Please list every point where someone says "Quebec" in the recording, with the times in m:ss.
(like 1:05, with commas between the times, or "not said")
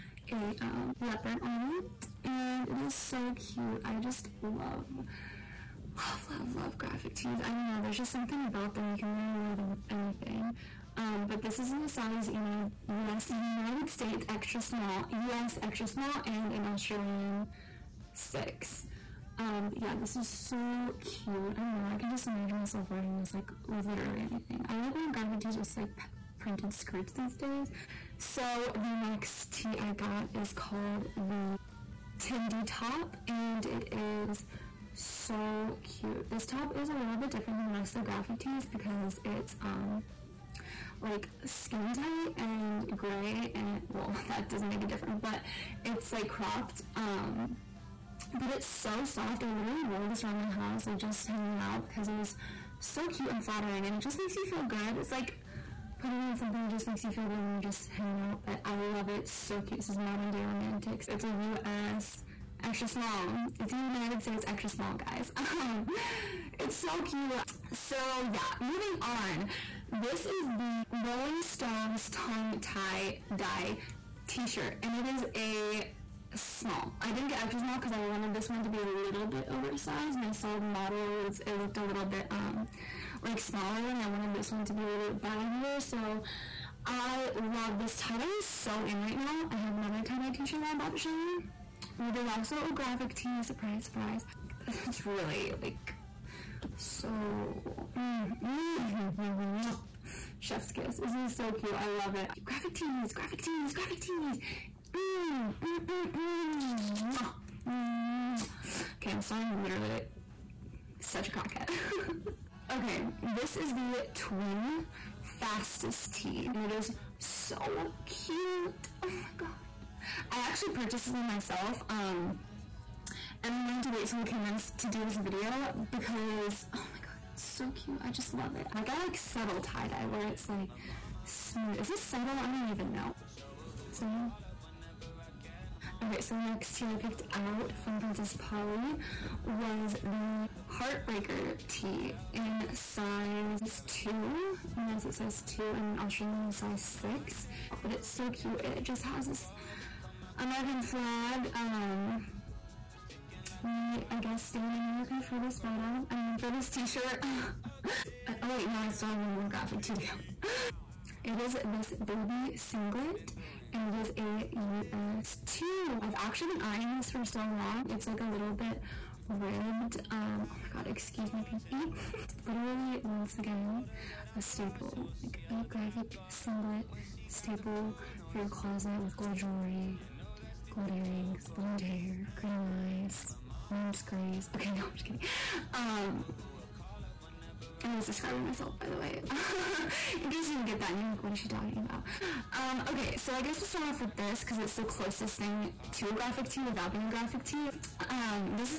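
not said.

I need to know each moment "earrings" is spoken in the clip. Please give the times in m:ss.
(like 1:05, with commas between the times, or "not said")
3:00.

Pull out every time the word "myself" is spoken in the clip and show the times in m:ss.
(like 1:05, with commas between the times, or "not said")
0:22, 2:01, 3:08.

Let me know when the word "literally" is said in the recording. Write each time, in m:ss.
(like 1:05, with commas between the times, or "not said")
0:09, 0:23, 0:49, 1:49, 2:52.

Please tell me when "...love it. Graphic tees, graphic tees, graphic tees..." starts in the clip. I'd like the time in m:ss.
1:41.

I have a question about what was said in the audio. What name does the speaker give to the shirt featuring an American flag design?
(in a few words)
Heartbreaker.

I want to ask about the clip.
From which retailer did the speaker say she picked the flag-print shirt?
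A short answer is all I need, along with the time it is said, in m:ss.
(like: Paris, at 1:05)
Princess Polly, at 2:17.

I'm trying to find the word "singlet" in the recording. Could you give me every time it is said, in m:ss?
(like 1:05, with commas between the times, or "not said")
2:42, 2:56.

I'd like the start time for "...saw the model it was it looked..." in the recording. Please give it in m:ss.
1:20.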